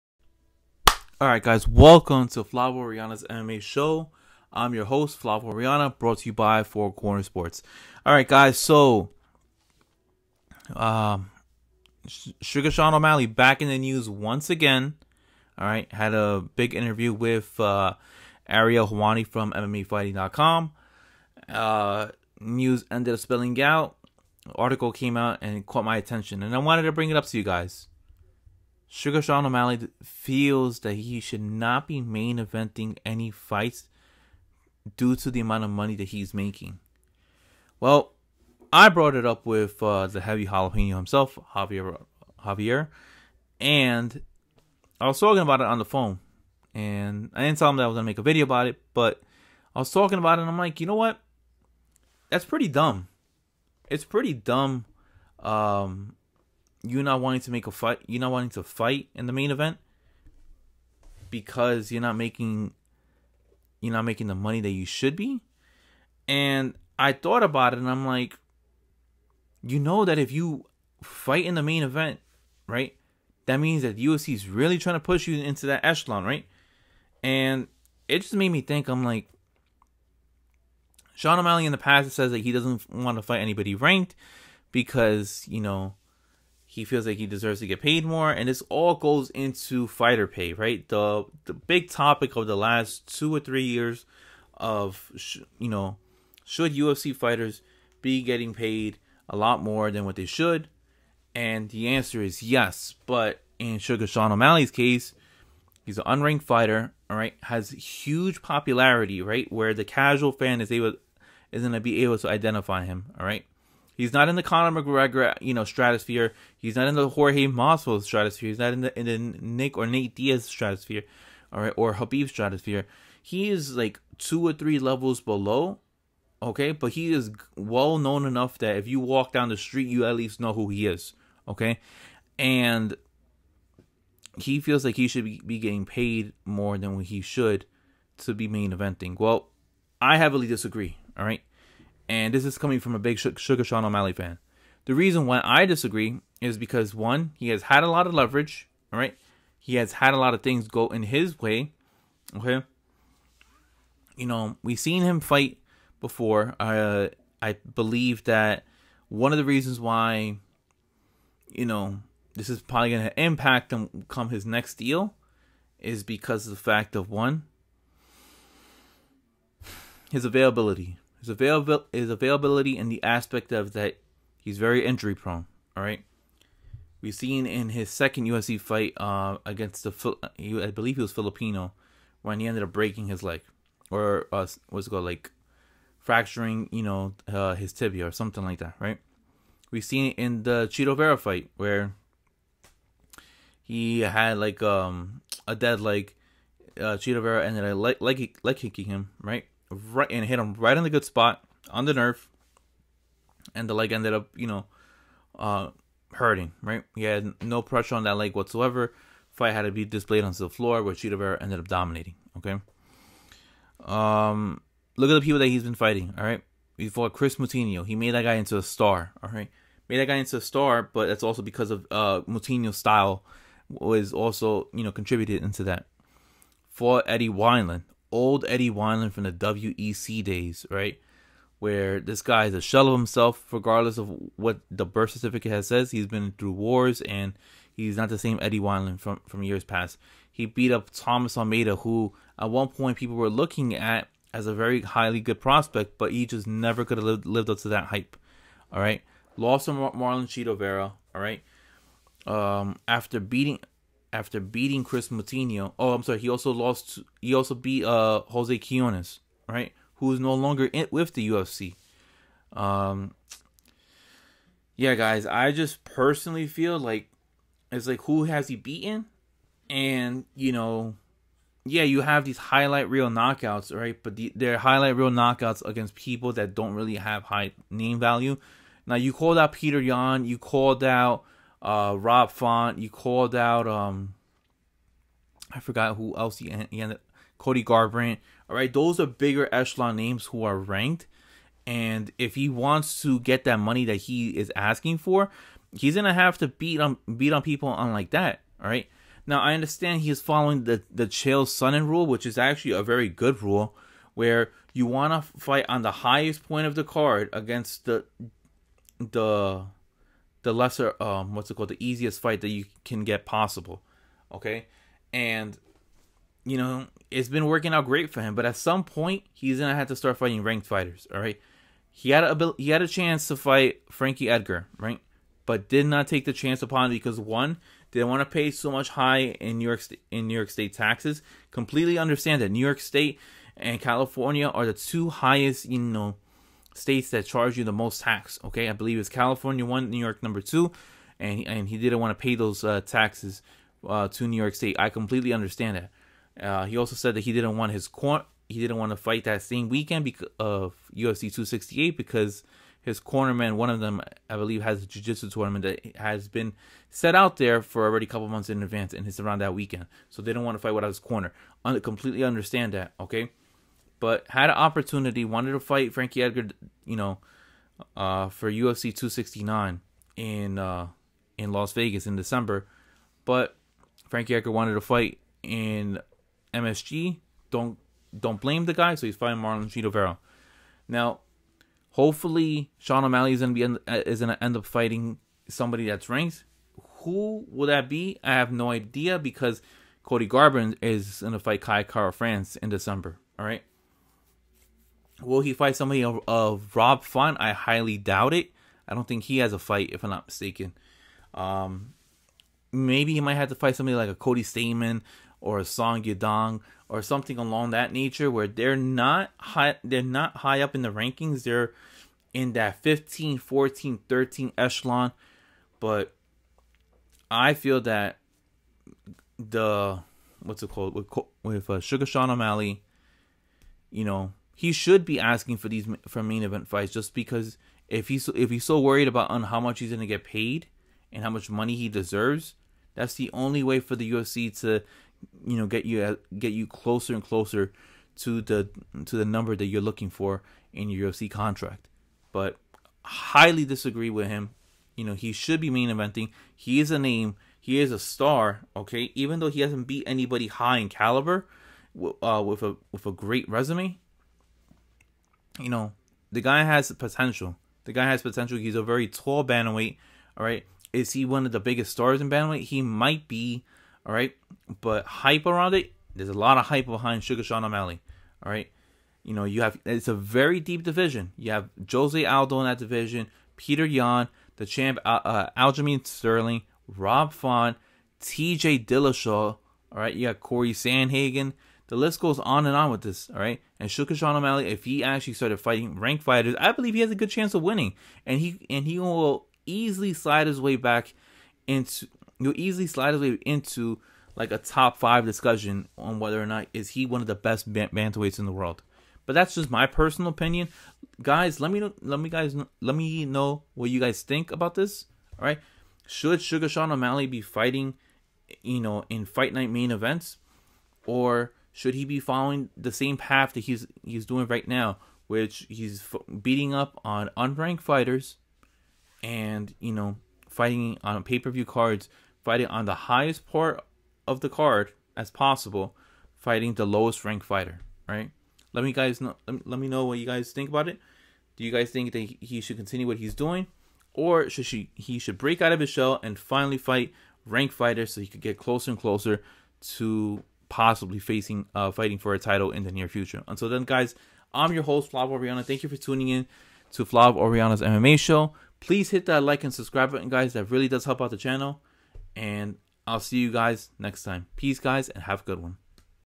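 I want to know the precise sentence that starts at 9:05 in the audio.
Thank you for tuning in to Flav Oriana's MMA show.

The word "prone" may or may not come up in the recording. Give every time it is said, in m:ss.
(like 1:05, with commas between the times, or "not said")
2:55.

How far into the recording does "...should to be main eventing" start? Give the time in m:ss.
2:17.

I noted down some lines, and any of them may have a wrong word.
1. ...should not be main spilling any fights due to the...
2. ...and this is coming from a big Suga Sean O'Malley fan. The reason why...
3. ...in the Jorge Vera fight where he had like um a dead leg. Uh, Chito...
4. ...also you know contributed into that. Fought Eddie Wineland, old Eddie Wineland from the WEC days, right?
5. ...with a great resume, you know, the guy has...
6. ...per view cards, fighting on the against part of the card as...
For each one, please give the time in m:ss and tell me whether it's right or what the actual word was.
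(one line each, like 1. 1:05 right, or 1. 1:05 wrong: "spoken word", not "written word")
1. 0:31 wrong: "eventing", not "spilling"
2. 2:22 right
3. 3:10 wrong: "Chito", not "Jorge"
4. 3:44 right
5. 7:32 right
6. 8:41 wrong: "highest", not "against".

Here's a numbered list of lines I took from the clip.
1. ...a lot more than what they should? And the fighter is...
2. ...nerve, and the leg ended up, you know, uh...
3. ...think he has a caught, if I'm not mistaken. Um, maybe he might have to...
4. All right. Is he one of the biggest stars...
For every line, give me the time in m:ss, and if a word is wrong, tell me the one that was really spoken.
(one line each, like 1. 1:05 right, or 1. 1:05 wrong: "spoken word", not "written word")
1. 1:39 wrong: "answer", not "fighter"
2. 3:21 right
3. 6:39 wrong: "fight", not "caught"
4. 7:40 right.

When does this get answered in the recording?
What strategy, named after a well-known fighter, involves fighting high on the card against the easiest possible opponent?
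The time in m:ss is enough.
5:01.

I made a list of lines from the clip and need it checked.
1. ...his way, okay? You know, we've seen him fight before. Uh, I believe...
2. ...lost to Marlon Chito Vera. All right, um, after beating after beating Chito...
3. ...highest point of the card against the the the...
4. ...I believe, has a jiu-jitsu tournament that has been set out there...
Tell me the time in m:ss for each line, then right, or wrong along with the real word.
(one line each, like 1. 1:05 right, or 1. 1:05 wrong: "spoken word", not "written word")
1. 2:31 right
2. 4:09 wrong: "Chris", not "Chito"
3. 5:05 right
4. 5:54 right.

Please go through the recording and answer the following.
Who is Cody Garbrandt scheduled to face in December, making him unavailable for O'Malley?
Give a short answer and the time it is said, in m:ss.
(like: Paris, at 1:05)
Kai Kara France, at 6:31.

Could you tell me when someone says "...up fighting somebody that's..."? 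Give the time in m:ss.
6:24.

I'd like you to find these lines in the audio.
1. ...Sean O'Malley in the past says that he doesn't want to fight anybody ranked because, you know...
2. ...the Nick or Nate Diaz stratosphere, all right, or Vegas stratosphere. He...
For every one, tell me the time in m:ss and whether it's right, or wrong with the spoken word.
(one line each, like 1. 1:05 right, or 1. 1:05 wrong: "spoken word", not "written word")
1. 1:21 right
2. 1:59 wrong: "Khabib", not "Vegas".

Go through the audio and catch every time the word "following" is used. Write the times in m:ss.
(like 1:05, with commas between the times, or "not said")
5:00, 8:32.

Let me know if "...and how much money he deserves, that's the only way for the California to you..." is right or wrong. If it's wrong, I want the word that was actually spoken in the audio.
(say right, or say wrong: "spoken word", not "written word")
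wrong: "UFC", not "California".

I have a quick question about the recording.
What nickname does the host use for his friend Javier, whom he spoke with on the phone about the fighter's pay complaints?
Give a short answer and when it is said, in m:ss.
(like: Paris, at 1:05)
the heavy jalapeno, at 0:40.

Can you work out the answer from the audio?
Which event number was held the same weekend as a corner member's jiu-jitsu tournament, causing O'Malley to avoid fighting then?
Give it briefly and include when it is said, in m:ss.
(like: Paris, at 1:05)
UFC 268, at 5:50.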